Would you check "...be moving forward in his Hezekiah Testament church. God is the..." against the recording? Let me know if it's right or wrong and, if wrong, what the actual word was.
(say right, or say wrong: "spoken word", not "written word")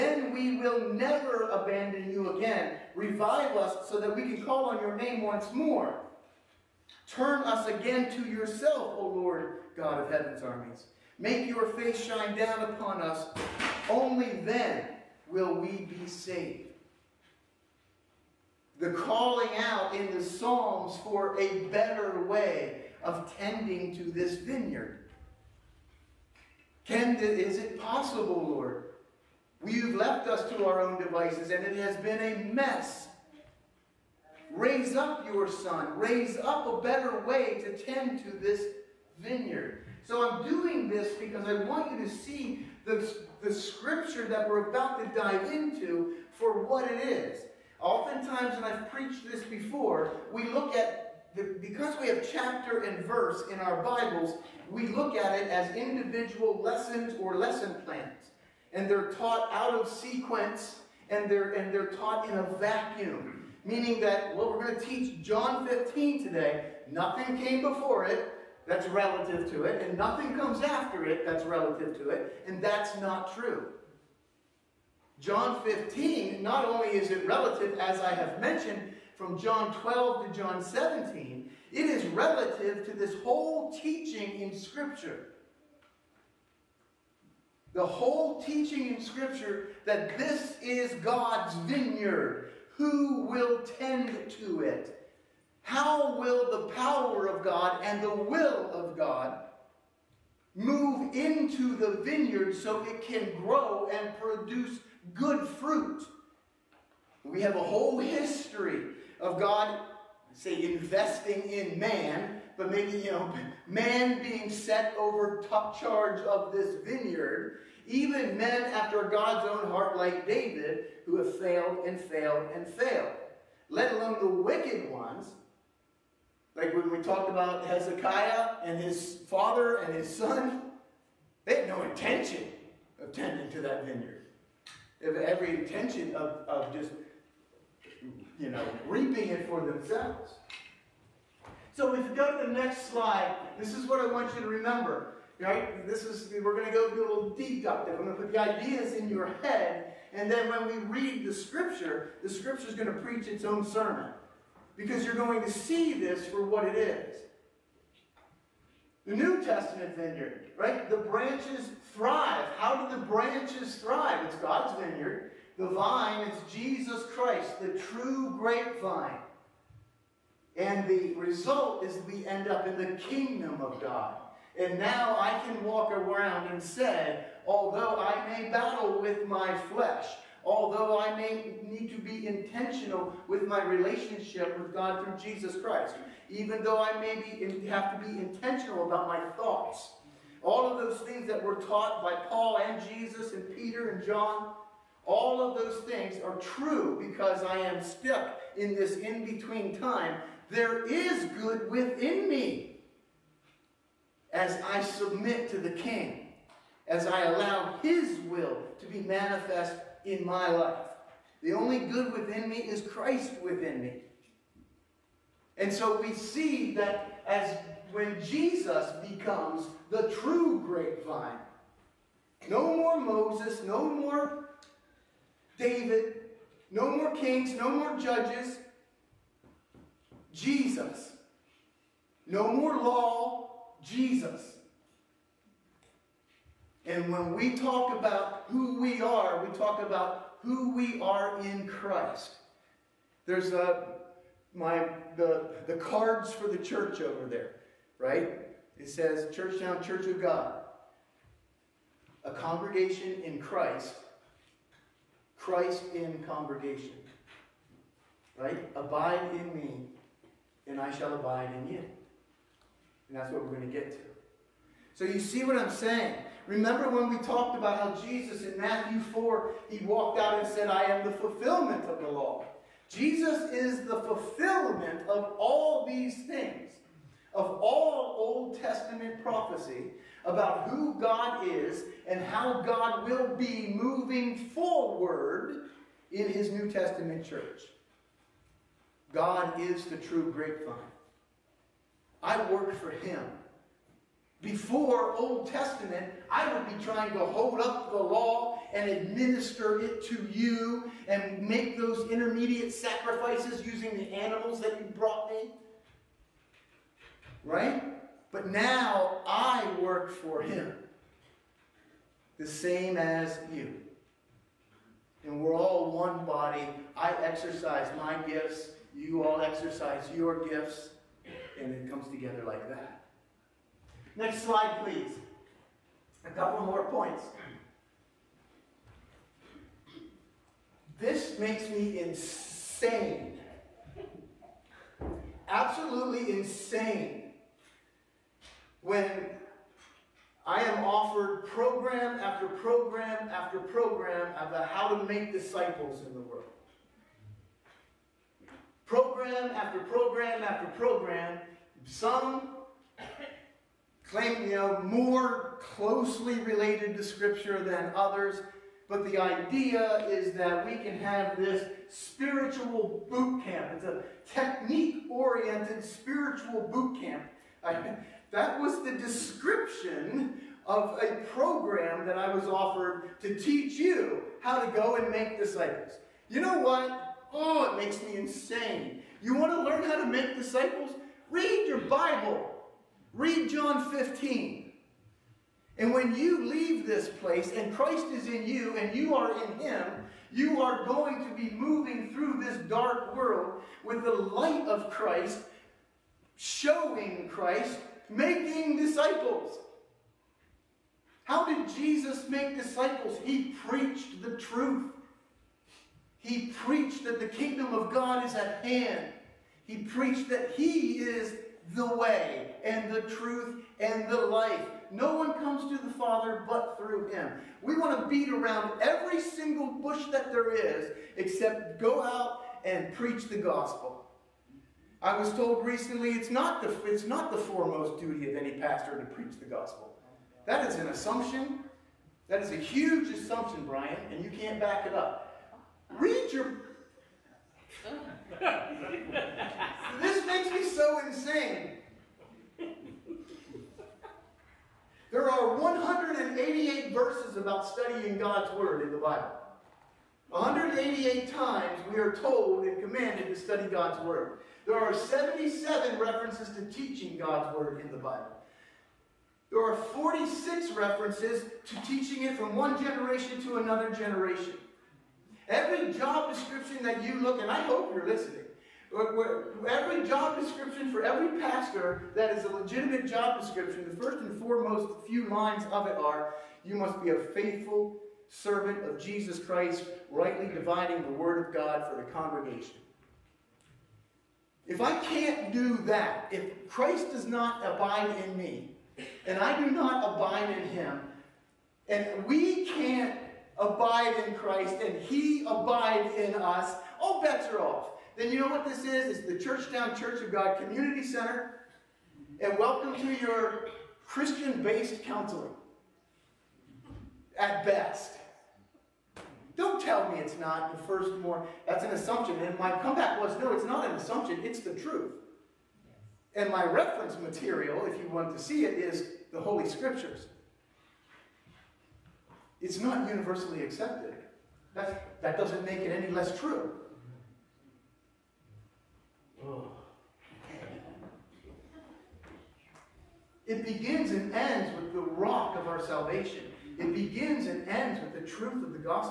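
wrong: "New", not "Hezekiah".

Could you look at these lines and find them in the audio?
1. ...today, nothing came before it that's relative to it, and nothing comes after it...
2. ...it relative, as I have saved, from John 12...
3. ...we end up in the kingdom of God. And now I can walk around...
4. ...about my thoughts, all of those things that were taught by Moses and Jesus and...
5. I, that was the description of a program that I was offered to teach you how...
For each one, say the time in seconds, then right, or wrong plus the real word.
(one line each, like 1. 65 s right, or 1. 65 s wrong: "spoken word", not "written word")
1. 66 s right
2. 77 s wrong: "mentioned", not "saved"
3. 172 s right
4. 188 s wrong: "Paul", not "Moses"
5. 367 s right.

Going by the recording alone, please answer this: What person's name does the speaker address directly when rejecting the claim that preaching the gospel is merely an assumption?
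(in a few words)
Brian.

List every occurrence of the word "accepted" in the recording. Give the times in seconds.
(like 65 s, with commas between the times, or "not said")
523 s.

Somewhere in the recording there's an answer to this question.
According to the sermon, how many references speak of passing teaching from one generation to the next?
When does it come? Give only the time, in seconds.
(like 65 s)
459 s.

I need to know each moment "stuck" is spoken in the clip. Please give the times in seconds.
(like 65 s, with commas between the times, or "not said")
197 s.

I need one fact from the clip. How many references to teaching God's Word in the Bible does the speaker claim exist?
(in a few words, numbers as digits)
77.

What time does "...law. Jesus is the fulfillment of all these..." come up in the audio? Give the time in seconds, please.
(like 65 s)
272 s.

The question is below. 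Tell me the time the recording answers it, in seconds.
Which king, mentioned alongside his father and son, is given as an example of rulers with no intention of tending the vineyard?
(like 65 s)
127 s.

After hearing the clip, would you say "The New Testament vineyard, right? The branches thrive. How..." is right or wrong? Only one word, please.
right.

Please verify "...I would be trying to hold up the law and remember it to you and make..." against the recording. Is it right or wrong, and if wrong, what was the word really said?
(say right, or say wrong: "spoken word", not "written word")
wrong: "administer", not "remember".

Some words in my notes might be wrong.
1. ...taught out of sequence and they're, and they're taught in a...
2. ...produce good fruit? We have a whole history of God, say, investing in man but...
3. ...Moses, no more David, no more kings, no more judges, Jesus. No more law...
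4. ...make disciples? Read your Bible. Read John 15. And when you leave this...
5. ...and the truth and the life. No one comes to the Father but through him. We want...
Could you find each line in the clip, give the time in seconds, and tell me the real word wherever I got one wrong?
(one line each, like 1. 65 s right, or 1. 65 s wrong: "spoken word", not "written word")
1. 59 s right
2. 104 s right
3. 222 s right
4. 380 s right
5. 412 s right.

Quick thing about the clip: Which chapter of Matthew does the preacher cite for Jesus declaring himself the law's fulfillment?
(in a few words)
Matthew 4.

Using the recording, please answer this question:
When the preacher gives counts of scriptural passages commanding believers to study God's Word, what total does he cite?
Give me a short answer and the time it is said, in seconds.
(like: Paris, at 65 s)
188, at 445 s.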